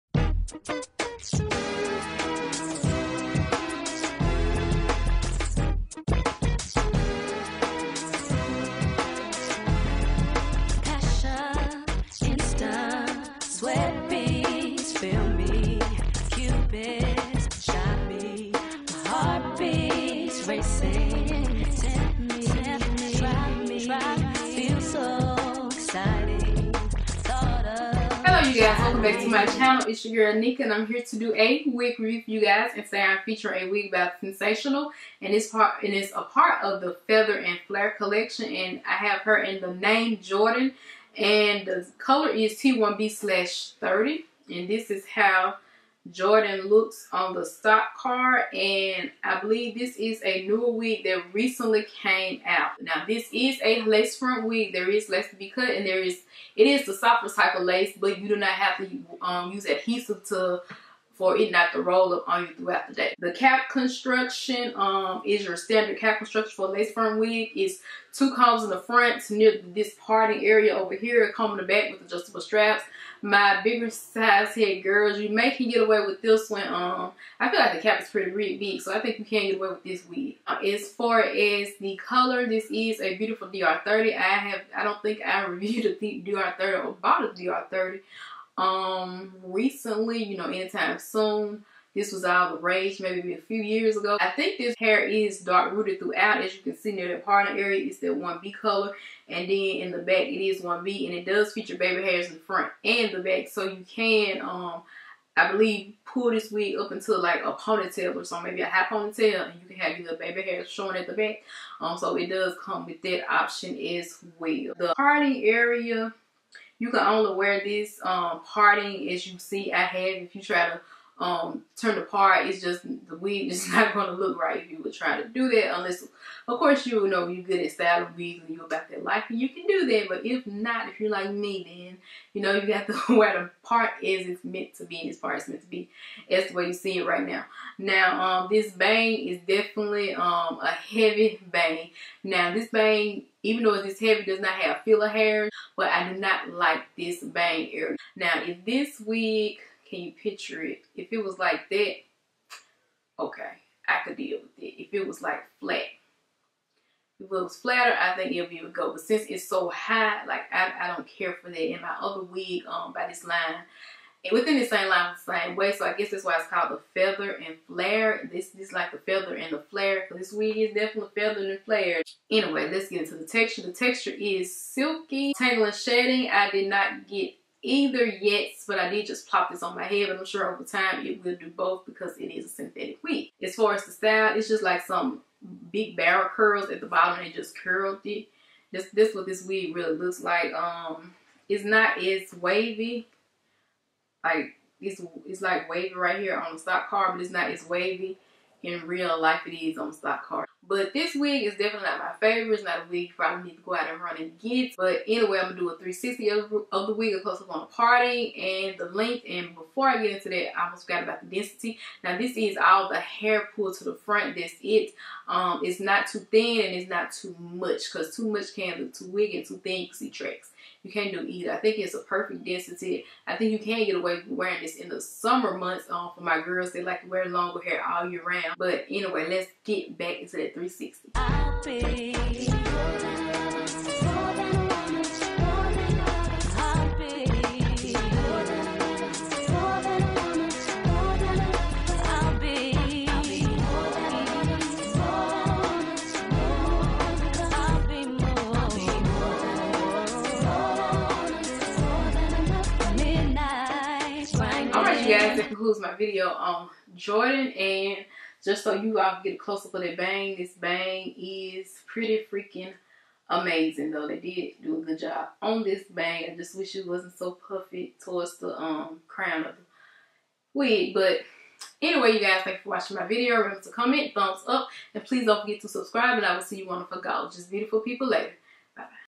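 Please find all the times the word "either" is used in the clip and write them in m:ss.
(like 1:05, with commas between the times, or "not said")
2:57, 3:41.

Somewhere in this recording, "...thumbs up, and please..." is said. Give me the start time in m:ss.
4:34.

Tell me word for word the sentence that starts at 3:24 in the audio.
But anyway, I'm going to do a 360 of, the wig, a close-up on a party and the length.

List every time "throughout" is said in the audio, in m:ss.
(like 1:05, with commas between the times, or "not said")
1:02, 1:35.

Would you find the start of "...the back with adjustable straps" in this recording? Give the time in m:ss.
1:11.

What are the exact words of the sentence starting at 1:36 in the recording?
As you can see near that parting area, it's that 1B color.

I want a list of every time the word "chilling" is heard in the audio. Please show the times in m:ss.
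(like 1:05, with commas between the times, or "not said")
not said.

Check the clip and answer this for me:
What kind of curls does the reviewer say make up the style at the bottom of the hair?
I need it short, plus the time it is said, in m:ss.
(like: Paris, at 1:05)
Big barrel curls, at 3:05.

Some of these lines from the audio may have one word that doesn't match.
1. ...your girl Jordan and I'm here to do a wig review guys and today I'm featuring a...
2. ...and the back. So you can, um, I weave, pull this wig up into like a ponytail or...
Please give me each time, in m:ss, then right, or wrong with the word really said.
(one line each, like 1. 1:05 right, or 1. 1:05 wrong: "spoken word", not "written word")
1. 0:30 wrong: "Nekka", not "Jordan"
2. 1:42 wrong: "believe", not "weave".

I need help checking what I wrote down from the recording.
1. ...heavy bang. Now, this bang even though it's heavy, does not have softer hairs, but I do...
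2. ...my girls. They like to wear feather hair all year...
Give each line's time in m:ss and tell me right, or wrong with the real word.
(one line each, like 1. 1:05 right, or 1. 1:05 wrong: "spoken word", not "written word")
1. 2:20 wrong: "filler", not "softer"
2. 3:46 wrong: "longer", not "feather".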